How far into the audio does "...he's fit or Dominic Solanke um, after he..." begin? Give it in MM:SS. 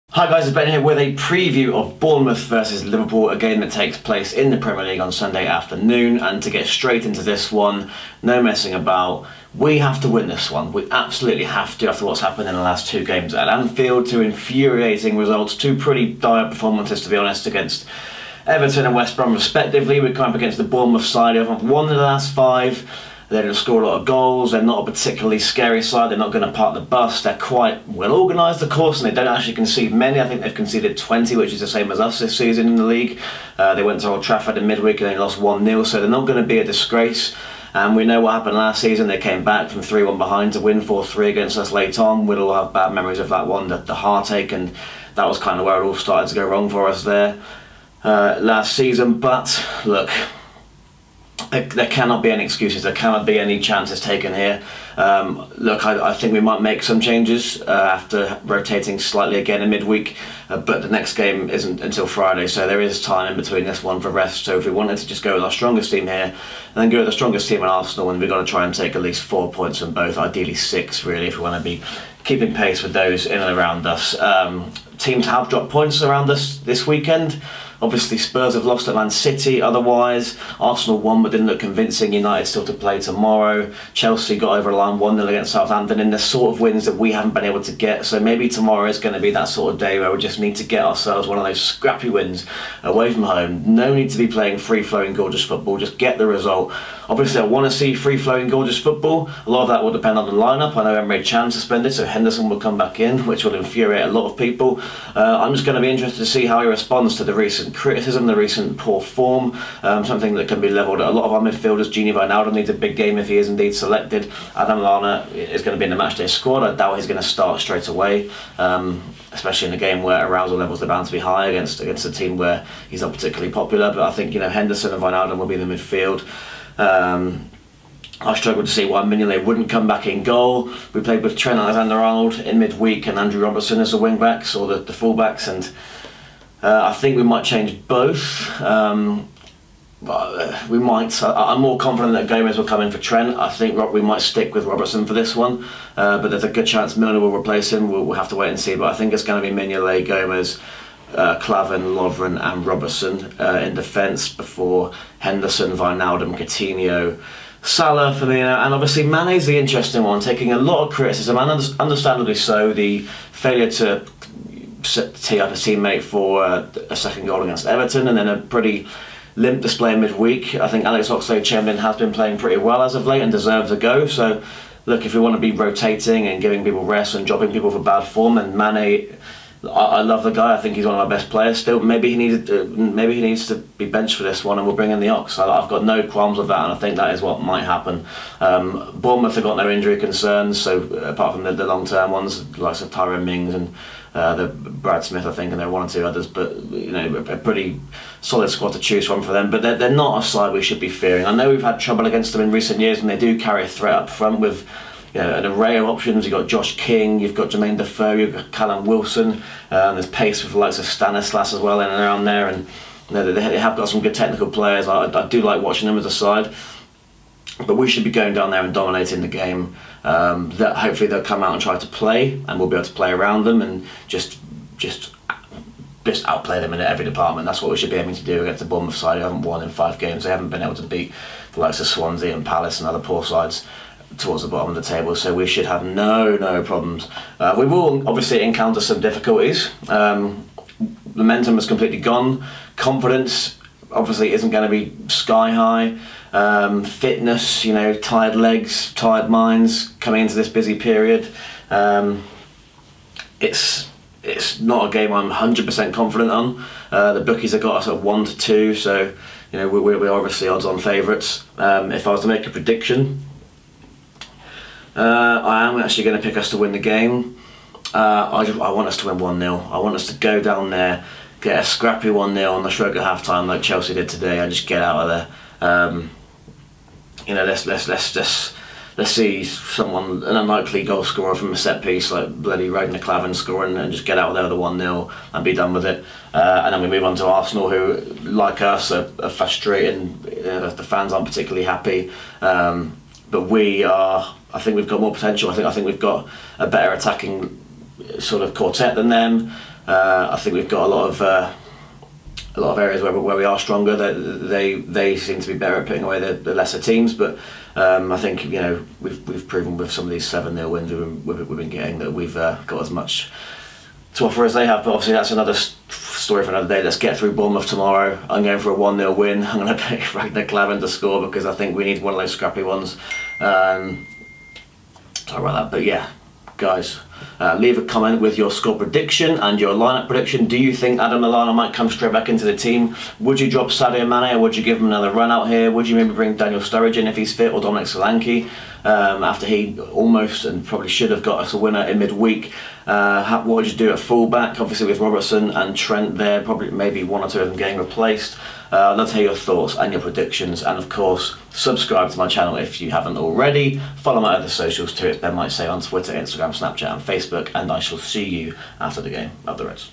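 05:37.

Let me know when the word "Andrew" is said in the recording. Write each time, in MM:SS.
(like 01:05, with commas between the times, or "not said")
02:13.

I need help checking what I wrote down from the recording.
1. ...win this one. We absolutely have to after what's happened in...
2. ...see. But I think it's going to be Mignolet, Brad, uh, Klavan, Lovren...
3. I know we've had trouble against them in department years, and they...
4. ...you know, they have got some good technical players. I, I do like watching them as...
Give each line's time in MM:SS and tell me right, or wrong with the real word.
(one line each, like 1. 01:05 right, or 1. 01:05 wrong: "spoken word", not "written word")
1. 00:10 right
2. 02:28 wrong: "Gomez", not "Brad"
3. 03:21 wrong: "recent", not "department"
4. 03:33 right.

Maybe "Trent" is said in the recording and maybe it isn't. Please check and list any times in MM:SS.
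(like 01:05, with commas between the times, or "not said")
02:11, 02:22, 05:45.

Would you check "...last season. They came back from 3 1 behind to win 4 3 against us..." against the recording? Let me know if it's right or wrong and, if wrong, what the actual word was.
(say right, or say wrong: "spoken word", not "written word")
right.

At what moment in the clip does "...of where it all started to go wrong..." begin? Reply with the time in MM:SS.
00:45.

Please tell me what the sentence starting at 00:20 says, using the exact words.
we come up against the Bournemouth side who have won the last five they're going to score a lot of goals.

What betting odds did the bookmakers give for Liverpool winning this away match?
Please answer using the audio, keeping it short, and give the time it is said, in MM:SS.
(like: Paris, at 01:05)
1 to 2, at 04:18.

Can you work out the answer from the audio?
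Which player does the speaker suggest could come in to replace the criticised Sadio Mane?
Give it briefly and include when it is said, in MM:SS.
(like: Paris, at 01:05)
Alex Oxlade-Chamberlain, at 02:50.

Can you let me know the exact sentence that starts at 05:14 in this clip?
But obviously that's another story for another day.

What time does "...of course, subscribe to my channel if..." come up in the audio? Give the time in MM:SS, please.
05:50.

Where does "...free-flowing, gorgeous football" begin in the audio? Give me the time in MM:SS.
01:37.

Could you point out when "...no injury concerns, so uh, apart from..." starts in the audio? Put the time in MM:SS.
03:09.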